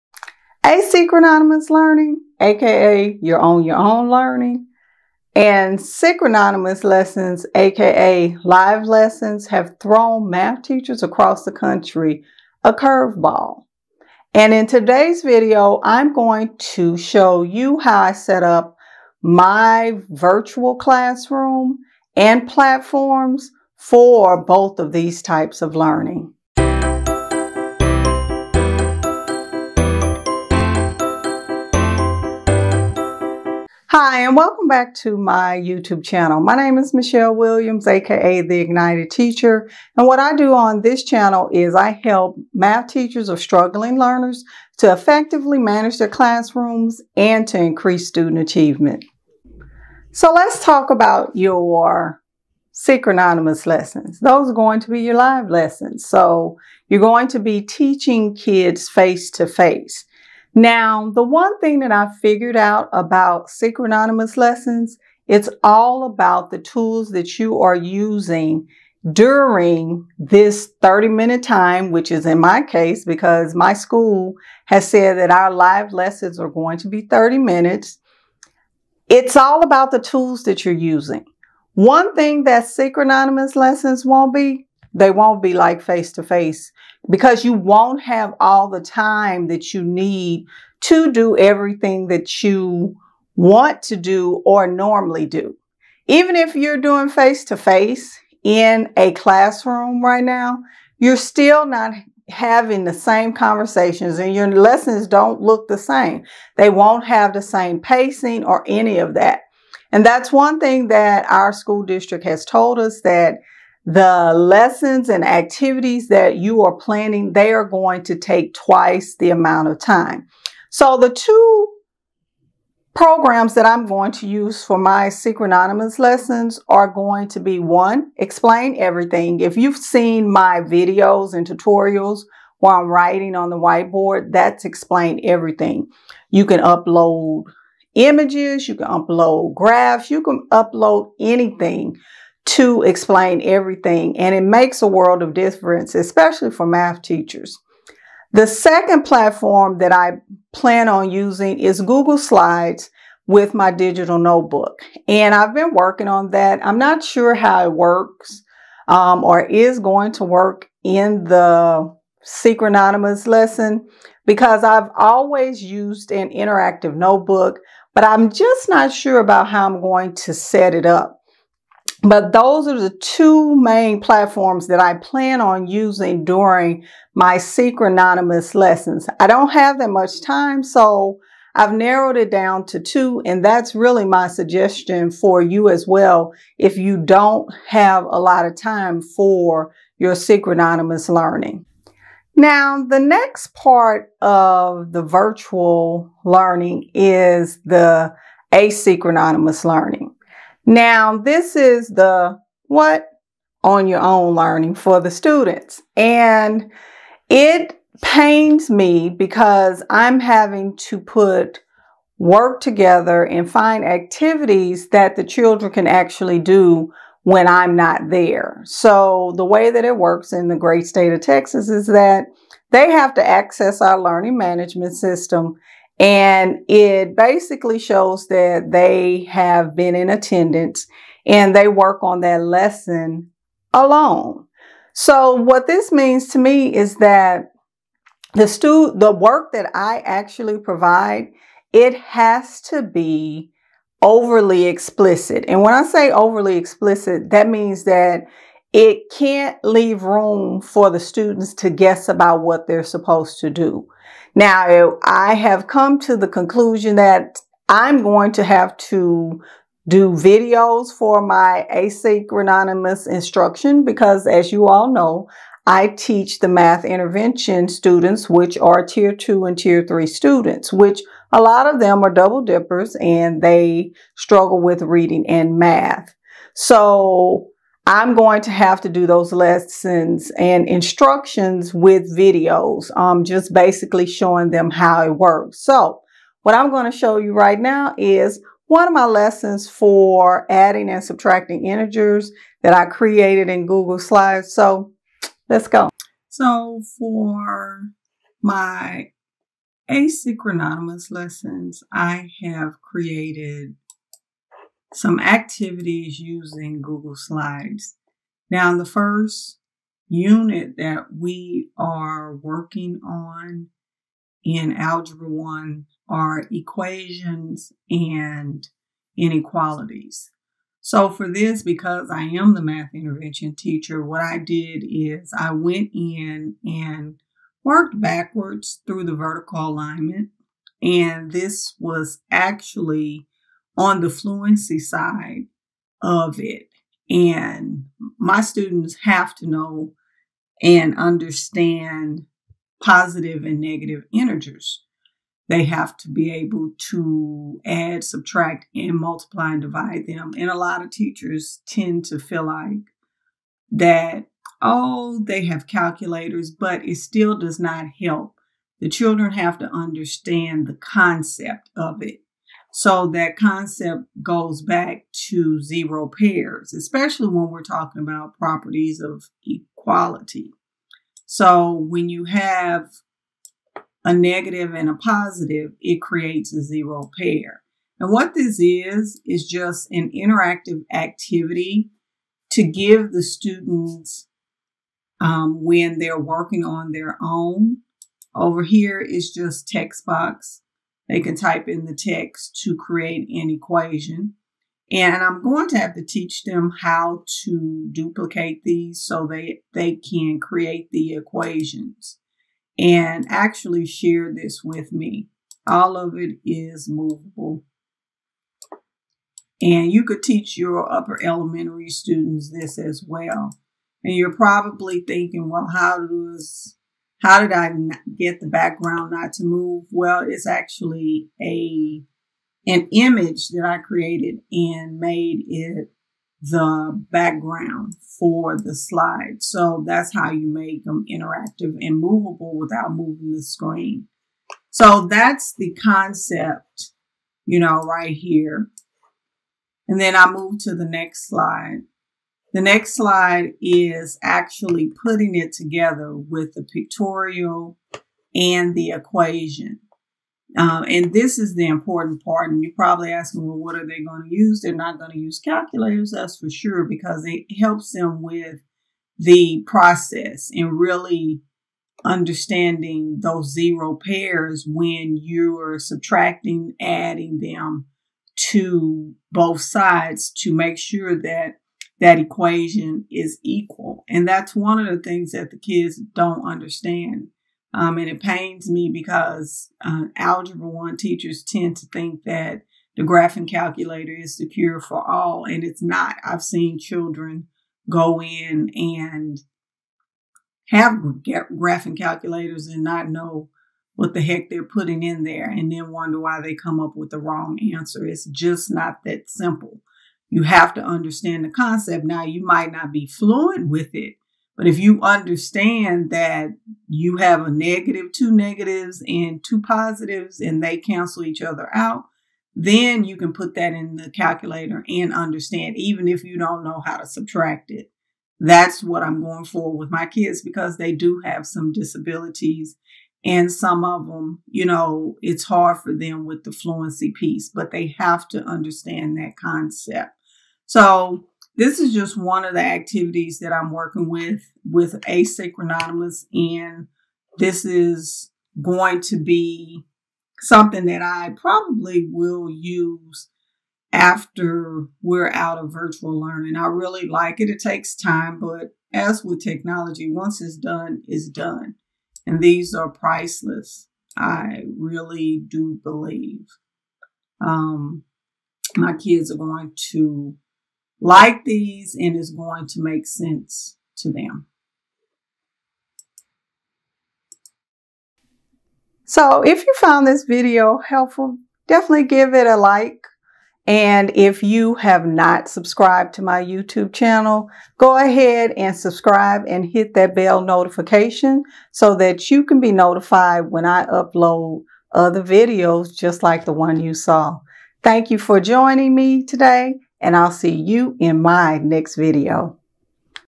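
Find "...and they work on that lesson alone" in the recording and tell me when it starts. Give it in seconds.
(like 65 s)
231 s.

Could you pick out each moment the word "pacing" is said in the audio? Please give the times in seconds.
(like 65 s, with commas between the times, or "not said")
107 s.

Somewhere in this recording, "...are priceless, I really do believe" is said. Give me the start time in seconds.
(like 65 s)
552 s.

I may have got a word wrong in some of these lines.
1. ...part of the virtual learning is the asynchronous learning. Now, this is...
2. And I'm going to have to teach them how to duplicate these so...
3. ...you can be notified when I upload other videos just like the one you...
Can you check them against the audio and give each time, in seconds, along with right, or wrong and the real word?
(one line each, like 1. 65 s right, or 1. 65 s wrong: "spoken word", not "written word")
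1. 193 s right
2. 394 s right
3. 582 s right.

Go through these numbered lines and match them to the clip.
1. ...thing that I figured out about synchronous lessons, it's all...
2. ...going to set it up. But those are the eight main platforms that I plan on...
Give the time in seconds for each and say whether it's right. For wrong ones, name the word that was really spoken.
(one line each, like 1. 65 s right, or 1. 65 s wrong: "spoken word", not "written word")
1. 61 s right
2. 169 s wrong: "two", not "eight".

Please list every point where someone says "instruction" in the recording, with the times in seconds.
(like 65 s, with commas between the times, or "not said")
263 s, 280 s.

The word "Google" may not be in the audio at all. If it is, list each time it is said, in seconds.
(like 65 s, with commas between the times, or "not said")
151 s, 293 s, 306 s.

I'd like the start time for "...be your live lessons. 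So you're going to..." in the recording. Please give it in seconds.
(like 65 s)
54 s.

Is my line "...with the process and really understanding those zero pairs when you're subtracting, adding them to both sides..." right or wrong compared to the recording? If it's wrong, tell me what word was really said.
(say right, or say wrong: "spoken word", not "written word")
right.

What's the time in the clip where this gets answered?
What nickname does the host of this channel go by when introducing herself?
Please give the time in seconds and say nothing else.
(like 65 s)
38 s.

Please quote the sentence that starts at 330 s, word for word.
And this was actually on the fluency side of it.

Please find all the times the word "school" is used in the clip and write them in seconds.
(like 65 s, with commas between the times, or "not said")
73 s, 111 s.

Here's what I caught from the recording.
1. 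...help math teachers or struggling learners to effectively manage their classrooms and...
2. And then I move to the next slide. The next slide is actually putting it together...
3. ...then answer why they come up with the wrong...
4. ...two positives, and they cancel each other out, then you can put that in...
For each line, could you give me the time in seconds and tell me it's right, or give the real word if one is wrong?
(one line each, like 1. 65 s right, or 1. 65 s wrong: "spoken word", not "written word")
1. 42 s right
2. 439 s right
3. 495 s wrong: "wonder", not "answer"
4. 509 s right.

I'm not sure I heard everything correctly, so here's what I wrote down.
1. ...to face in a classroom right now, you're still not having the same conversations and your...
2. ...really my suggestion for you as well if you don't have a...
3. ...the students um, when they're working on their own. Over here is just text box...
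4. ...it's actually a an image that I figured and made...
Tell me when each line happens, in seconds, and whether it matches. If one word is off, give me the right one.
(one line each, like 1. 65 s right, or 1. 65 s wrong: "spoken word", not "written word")
1. 97 s right
2. 183 s right
3. 383 s right
4. 420 s wrong: "created", not "figured".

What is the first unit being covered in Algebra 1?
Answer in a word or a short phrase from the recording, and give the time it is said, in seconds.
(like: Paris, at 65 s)
equations and inequalities, at 316 s.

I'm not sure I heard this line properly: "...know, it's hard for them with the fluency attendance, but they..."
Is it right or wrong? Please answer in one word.
wrong.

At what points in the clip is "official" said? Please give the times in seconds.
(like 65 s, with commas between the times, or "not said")
not said.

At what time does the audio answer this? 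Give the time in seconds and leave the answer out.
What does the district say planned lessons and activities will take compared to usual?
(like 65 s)
118 s.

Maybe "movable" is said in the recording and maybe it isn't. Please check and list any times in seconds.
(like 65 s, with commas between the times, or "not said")
406 s, 431 s.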